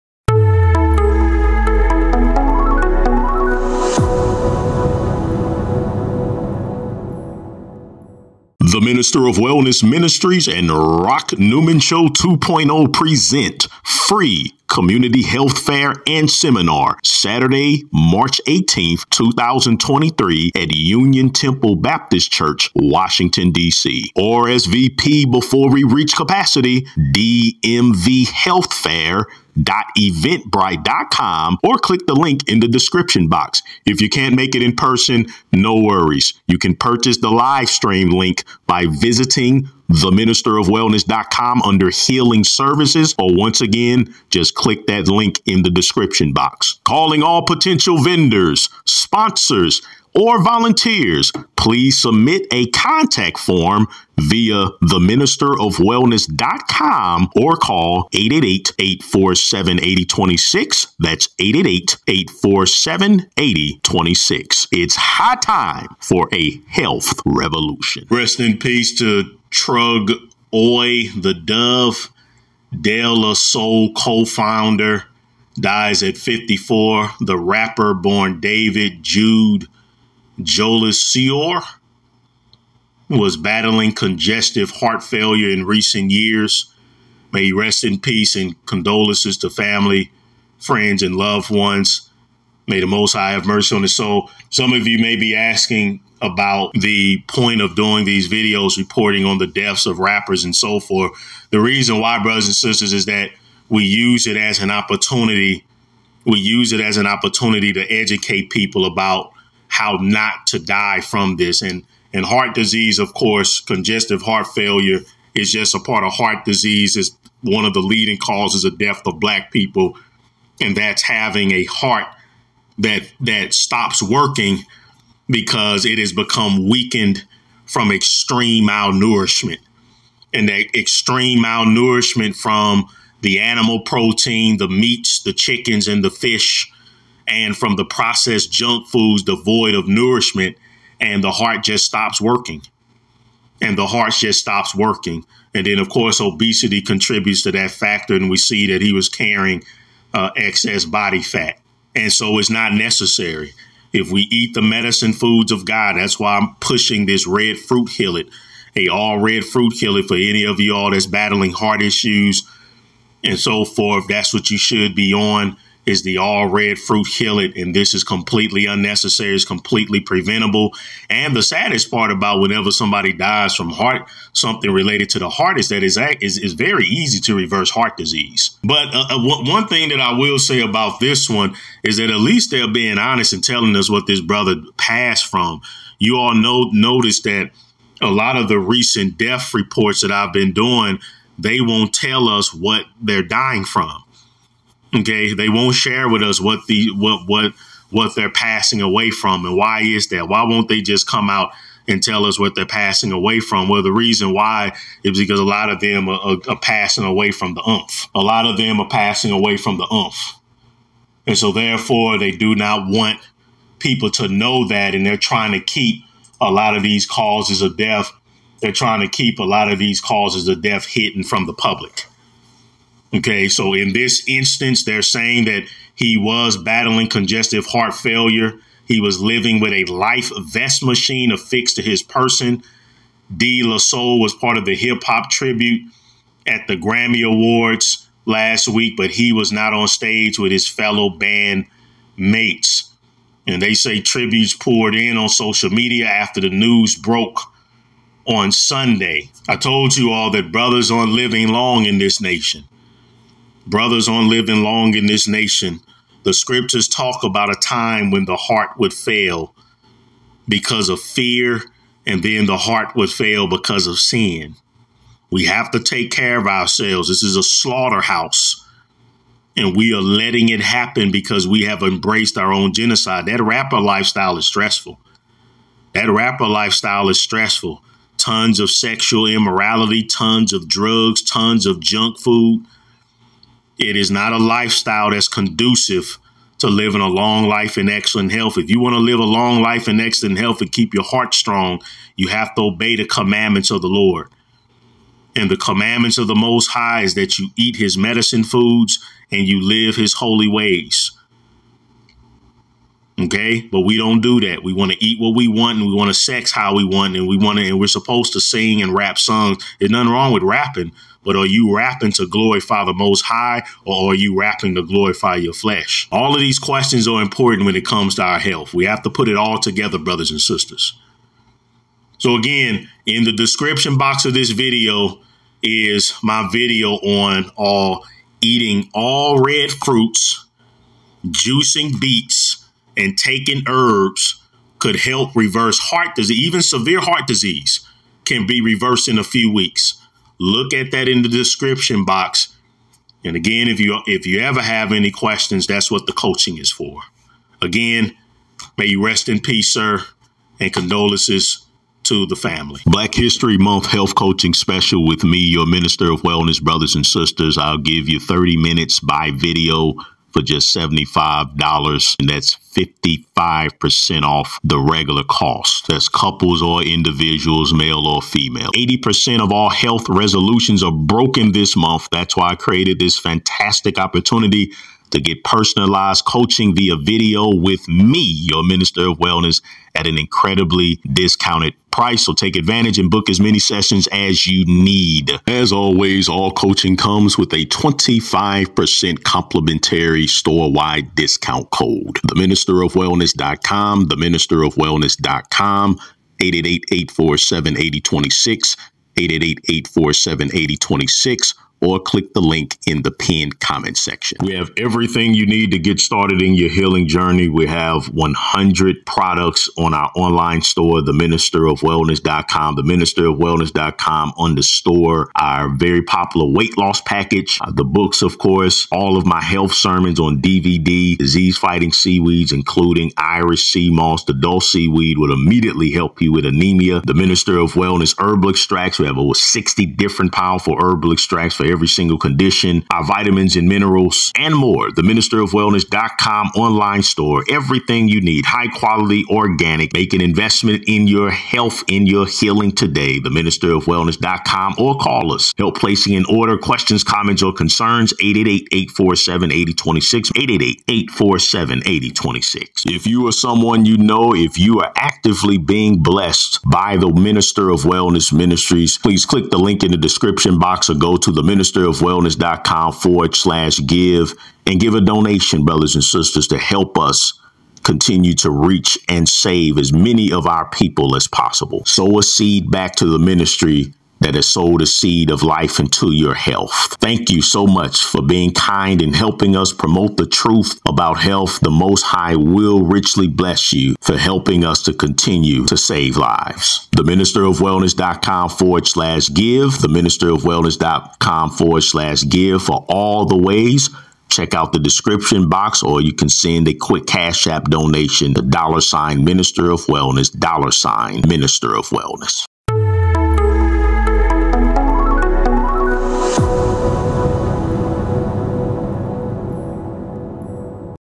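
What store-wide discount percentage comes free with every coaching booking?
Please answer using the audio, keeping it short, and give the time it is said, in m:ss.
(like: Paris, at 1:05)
25%, at 6:27.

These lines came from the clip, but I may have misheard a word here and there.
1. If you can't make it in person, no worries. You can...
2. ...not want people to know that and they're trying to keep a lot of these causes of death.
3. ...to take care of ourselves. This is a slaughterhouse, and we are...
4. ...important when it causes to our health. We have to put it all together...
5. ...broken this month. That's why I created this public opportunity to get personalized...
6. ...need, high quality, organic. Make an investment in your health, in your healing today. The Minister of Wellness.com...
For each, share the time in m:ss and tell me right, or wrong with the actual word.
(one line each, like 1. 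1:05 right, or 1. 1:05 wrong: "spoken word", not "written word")
1. 0:33 right
2. 3:32 right
3. 4:25 right
4. 5:17 wrong: "comes", not "causes"
5. 6:10 wrong: "fantastic", not "public"
6. 7:18 right.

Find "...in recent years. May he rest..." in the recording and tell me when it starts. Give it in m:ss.
1:25.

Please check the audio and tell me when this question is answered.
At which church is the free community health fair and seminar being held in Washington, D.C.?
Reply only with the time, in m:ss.
0:20.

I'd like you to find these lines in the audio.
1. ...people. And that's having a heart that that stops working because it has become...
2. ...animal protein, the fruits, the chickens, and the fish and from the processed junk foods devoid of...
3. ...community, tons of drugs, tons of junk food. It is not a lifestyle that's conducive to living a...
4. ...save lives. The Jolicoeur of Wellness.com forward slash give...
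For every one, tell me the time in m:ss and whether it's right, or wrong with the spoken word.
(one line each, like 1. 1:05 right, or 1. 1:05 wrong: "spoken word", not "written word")
1. 1:59 right
2. 2:13 wrong: "meats", not "fruits"
3. 4:39 wrong: "immorality", not "community"
4. 8:05 wrong: "Minister", not "Jolicoeur".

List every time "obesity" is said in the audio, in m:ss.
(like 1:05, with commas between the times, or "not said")
2:26.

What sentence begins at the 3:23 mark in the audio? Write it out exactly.
Well, the reason why is because a lot of them are, are, are passing away from the umph.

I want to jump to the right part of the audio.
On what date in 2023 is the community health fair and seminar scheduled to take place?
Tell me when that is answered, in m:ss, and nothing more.
0:17.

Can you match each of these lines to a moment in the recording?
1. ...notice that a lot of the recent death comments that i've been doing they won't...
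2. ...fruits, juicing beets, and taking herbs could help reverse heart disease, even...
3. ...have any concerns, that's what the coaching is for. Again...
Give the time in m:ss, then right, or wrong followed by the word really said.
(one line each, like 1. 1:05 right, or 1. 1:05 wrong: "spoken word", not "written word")
1. 3:06 wrong: "reports", not "comments"
2. 5:29 right
3. 5:44 wrong: "questions", not "concerns".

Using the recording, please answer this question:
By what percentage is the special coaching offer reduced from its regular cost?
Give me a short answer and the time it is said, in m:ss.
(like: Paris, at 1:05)
55%, at 6:02.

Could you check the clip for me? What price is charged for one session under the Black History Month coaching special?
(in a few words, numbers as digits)
$75.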